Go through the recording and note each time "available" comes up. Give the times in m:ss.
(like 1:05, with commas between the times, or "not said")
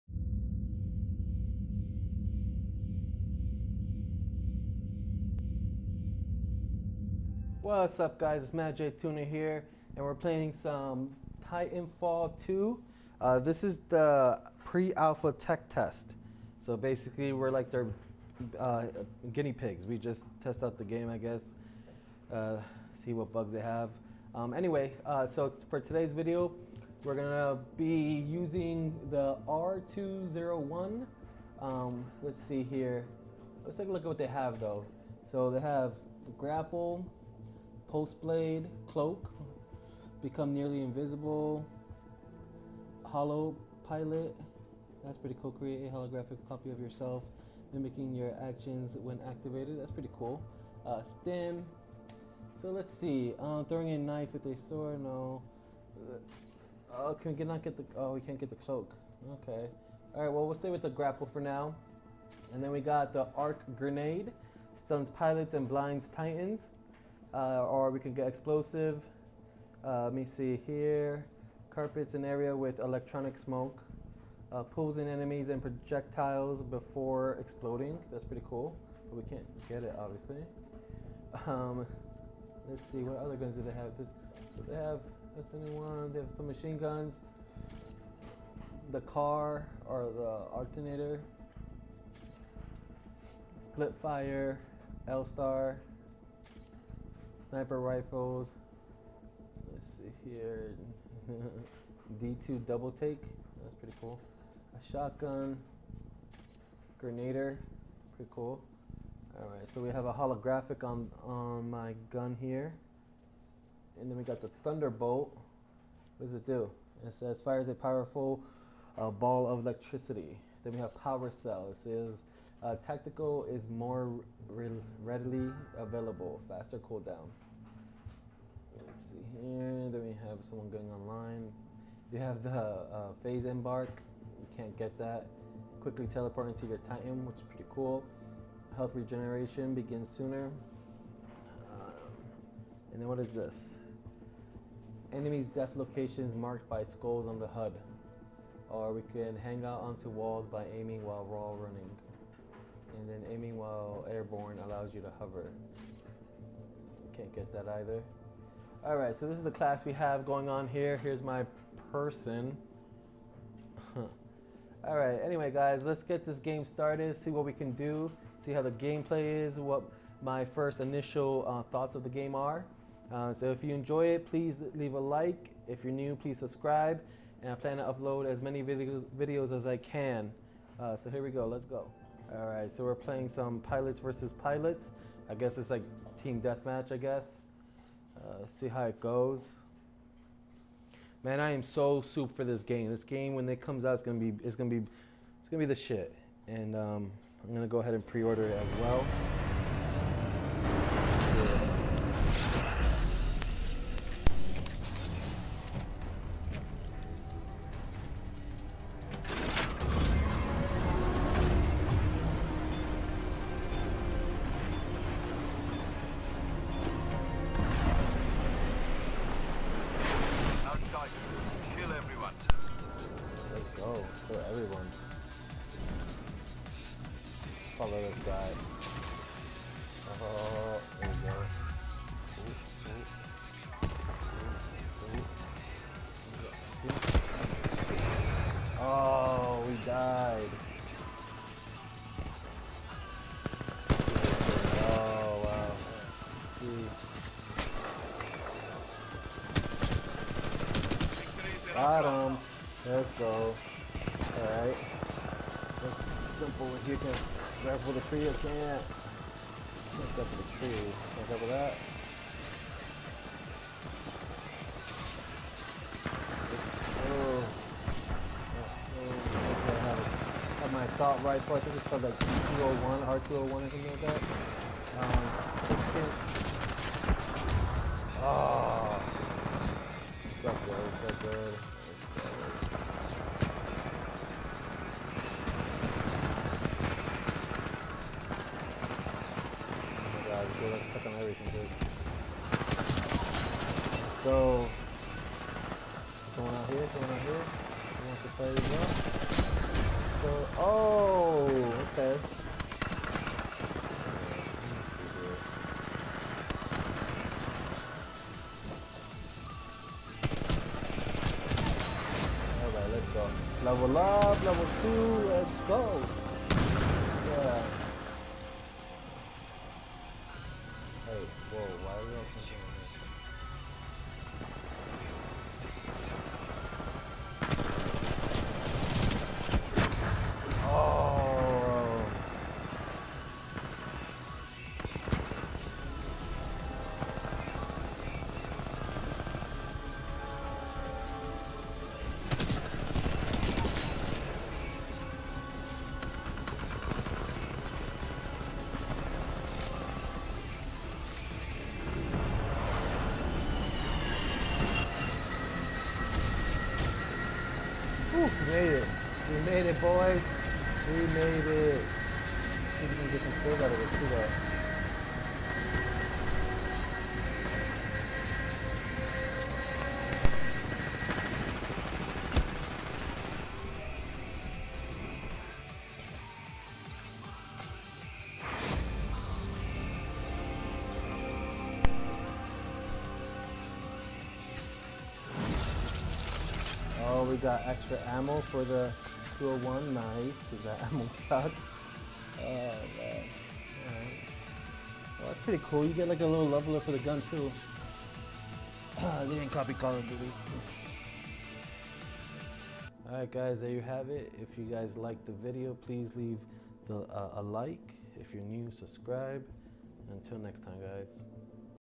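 2:05.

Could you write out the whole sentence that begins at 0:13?
Uh, this is the pre-alpha tech test.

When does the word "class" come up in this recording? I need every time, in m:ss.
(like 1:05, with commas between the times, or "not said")
2:39.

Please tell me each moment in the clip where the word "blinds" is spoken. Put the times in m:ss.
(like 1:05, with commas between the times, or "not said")
1:05.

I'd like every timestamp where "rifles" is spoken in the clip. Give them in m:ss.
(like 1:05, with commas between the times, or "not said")
1:37, 4:31.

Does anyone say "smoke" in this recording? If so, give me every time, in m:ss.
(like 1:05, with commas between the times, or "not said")
1:13.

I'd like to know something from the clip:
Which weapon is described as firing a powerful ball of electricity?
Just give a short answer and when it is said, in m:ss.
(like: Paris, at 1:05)
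Thunderbolt, at 1:54.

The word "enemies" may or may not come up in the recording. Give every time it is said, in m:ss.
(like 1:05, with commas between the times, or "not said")
1:15, 2:25.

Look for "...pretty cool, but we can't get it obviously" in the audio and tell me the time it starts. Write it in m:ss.
1:18.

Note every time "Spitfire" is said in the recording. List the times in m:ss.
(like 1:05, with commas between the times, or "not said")
1:33.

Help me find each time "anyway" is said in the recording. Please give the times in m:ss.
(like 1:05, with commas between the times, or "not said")
0:24, 2:45.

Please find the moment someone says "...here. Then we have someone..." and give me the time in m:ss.
2:09.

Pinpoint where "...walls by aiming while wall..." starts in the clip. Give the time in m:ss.
2:30.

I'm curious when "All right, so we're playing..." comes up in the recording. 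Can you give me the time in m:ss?
3:02.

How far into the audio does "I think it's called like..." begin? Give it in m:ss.
4:31.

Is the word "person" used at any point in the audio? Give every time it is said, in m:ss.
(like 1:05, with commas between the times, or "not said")
2:41.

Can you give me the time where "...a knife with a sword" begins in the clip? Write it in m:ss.
0:53.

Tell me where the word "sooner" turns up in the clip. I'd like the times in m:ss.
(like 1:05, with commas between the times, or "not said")
2:20.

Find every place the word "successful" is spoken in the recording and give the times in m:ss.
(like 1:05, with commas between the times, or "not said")
not said.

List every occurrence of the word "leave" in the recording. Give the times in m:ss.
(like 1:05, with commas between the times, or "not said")
2:54, 6:46.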